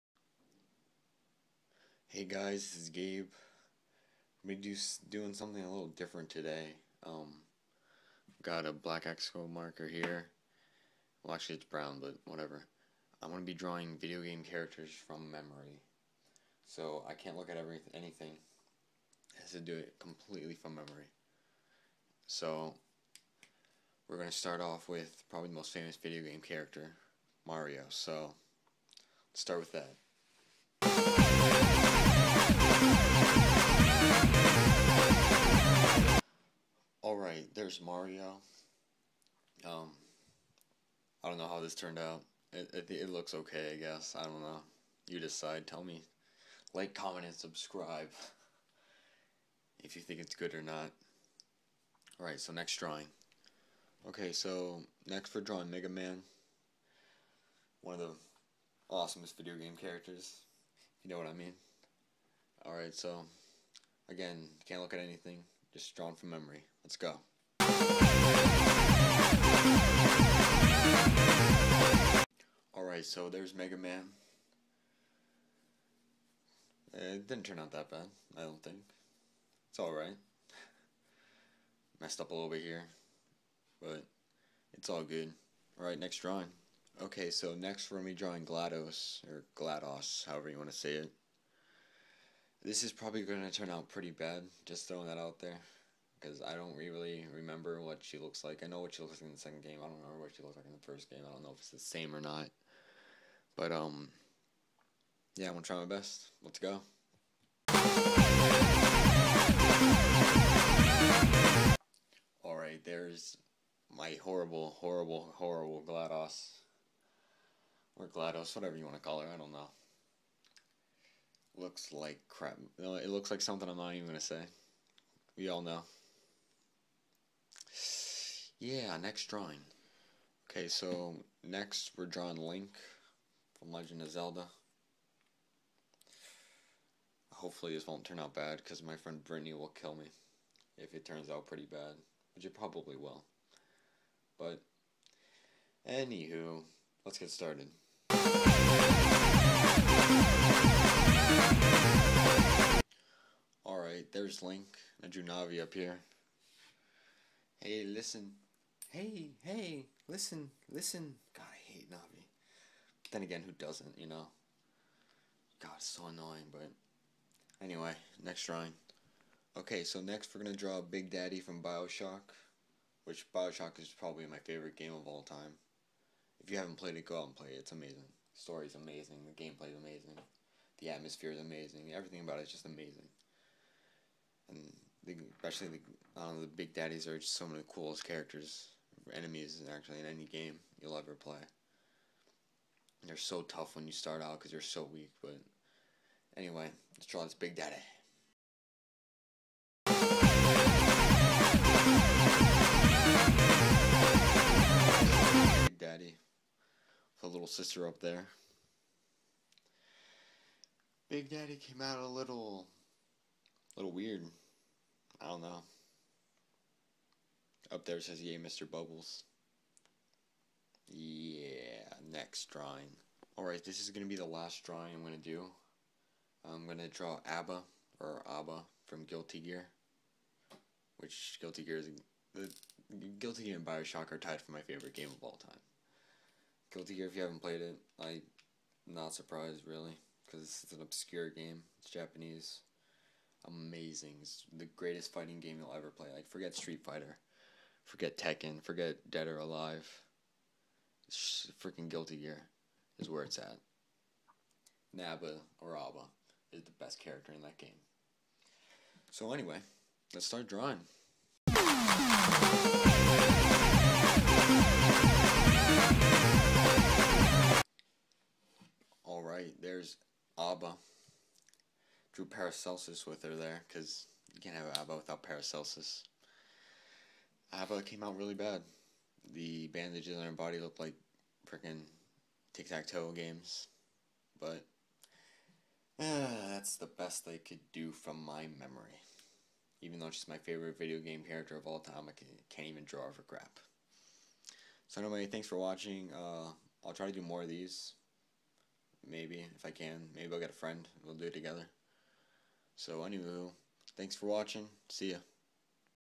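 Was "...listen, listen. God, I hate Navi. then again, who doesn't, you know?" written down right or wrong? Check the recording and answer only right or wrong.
right.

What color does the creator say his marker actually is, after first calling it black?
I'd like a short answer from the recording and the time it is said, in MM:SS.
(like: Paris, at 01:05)
Brown, at 00:11.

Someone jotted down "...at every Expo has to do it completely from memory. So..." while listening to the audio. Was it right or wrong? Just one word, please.
wrong.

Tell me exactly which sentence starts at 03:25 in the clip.
Big daddy, with a little sister up there.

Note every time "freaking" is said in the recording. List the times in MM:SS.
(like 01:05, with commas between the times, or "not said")
04:11, 04:41.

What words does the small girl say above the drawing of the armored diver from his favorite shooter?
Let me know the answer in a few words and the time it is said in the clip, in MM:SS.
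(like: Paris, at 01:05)
Yay, Mr. Bubbles, at 03:38.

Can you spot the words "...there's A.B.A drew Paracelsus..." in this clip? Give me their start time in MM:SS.
04:29.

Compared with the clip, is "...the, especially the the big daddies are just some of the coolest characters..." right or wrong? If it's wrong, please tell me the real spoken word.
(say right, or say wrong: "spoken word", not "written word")
right.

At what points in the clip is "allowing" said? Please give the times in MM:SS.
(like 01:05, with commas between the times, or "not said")
not said.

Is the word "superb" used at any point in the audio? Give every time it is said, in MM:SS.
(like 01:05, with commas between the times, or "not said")
not said.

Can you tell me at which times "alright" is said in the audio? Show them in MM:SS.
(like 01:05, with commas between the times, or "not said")
00:52, 01:02, 01:12, 01:19, 01:25, 01:52, 03:43.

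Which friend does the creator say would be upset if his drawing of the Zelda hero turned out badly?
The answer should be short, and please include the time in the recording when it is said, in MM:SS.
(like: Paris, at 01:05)
Brittany, at 02:19.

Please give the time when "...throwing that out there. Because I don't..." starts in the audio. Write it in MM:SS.
01:34.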